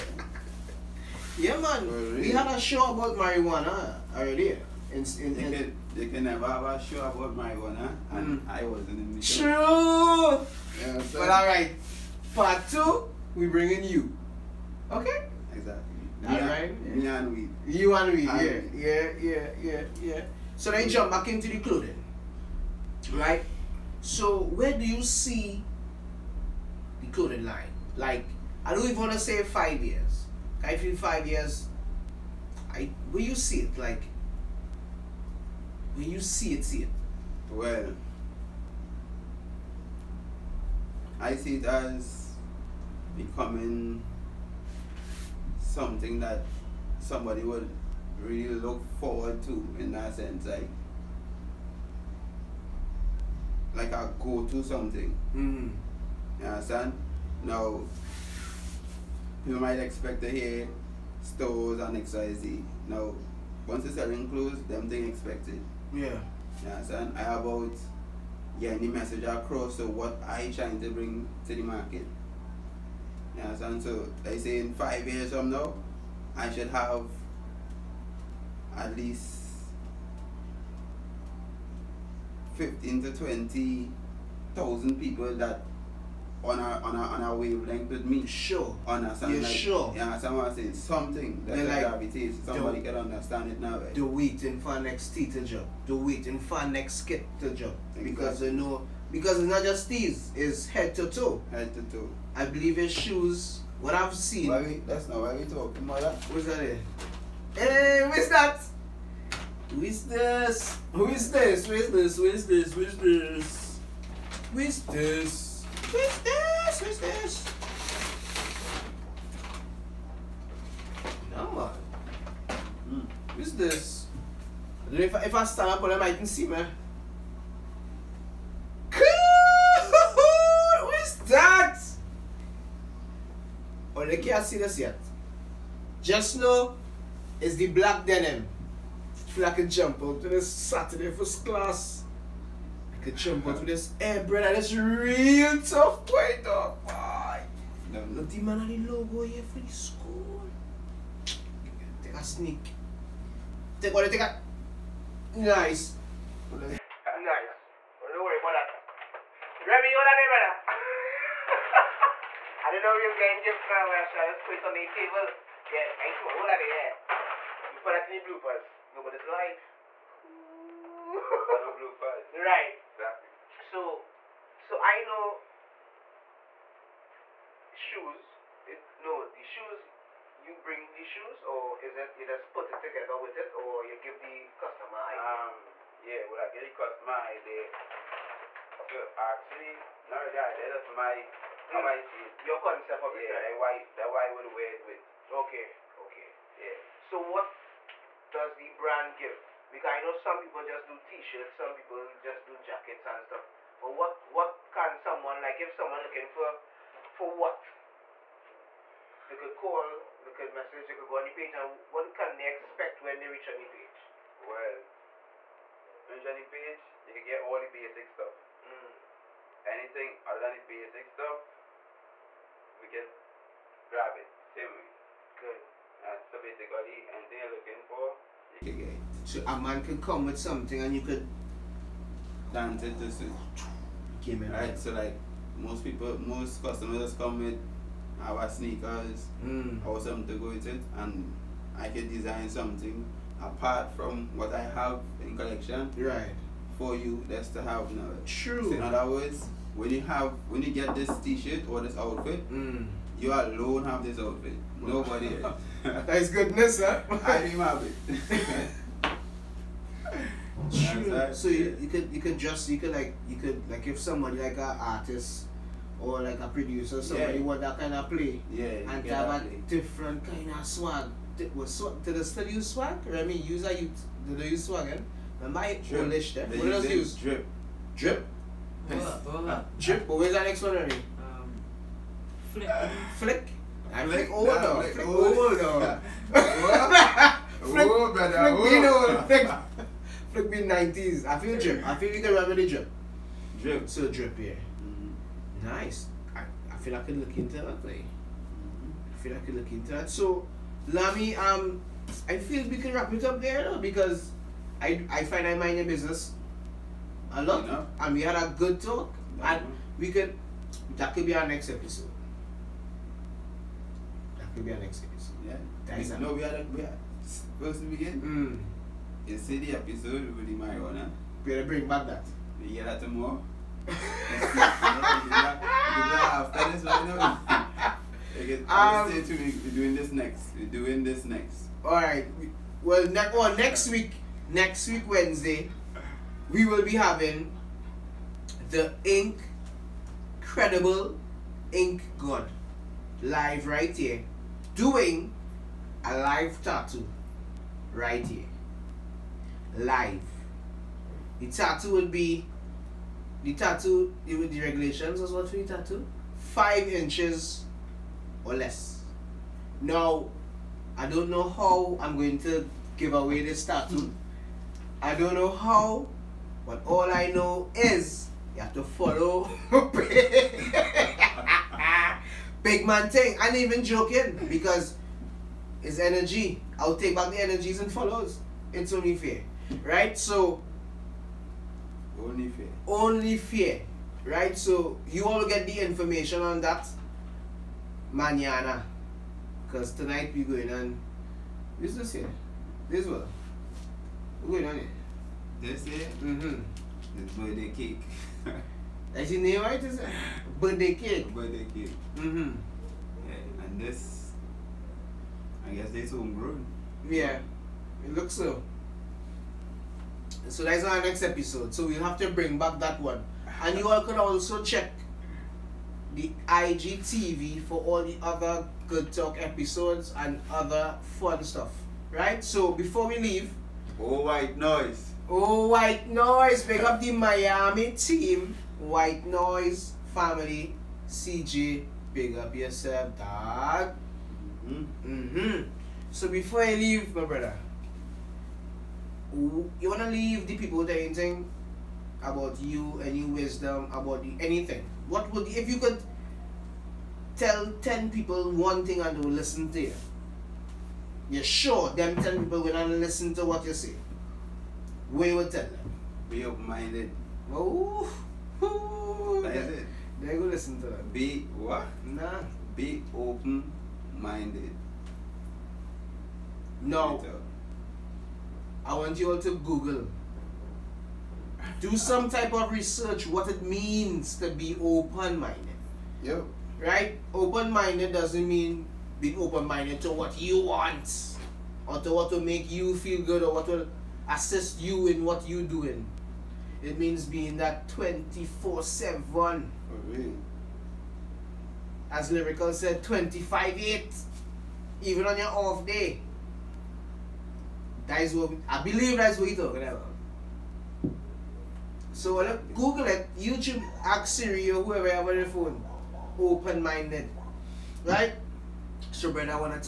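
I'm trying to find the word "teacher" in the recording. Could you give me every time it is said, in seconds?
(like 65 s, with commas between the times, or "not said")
95 s.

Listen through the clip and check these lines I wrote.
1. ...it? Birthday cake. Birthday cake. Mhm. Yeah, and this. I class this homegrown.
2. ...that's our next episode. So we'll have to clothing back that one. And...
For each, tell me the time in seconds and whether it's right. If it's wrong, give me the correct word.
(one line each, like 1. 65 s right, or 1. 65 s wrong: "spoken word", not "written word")
1. 399 s wrong: "guess", not "class"
2. 410 s wrong: "bring", not "clothing".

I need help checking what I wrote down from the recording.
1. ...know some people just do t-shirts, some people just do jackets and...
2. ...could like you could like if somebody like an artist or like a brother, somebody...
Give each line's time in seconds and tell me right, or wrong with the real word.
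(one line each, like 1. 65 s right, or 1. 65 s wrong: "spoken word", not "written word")
1. 200 s right
2. 262 s wrong: "producer", not "brother".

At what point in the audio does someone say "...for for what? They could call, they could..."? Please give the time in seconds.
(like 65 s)
206 s.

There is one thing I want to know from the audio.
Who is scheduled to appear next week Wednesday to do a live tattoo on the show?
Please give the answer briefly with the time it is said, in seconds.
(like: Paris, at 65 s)
Ink Credible Ink God, at 339 s.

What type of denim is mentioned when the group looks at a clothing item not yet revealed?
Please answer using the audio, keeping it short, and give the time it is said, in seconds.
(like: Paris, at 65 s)
Black denim, at 137 s.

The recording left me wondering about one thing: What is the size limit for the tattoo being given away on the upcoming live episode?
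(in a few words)
Five inches or less.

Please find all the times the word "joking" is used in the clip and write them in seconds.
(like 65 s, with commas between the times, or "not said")
373 s.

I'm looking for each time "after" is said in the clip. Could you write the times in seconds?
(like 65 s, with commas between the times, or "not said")
323 s.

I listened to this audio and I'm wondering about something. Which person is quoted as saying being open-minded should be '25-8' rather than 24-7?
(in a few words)
Lyrical.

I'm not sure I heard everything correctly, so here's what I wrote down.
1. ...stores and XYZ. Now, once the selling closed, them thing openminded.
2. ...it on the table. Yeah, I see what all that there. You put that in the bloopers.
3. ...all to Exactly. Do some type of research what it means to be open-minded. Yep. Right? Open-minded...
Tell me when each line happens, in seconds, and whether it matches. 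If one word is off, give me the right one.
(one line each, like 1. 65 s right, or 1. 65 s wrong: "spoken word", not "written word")
1. 61 s wrong: "expected", not "openminded"
2. 164 s right
3. 469 s wrong: "Google", not "Exactly".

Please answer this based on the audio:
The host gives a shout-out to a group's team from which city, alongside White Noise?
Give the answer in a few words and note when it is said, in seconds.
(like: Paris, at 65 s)
Miami, at 427 s.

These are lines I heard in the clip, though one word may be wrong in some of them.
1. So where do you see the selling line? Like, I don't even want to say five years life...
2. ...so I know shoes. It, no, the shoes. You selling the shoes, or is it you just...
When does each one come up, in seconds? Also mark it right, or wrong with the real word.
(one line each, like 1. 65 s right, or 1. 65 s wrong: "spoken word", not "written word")
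1. 24 s wrong: "clothing", not "selling"
2. 174 s wrong: "bring", not "selling".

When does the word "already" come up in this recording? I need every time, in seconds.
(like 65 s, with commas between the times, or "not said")
4 s, 280 s.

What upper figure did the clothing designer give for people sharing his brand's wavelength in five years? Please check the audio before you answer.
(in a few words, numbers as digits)
20,000.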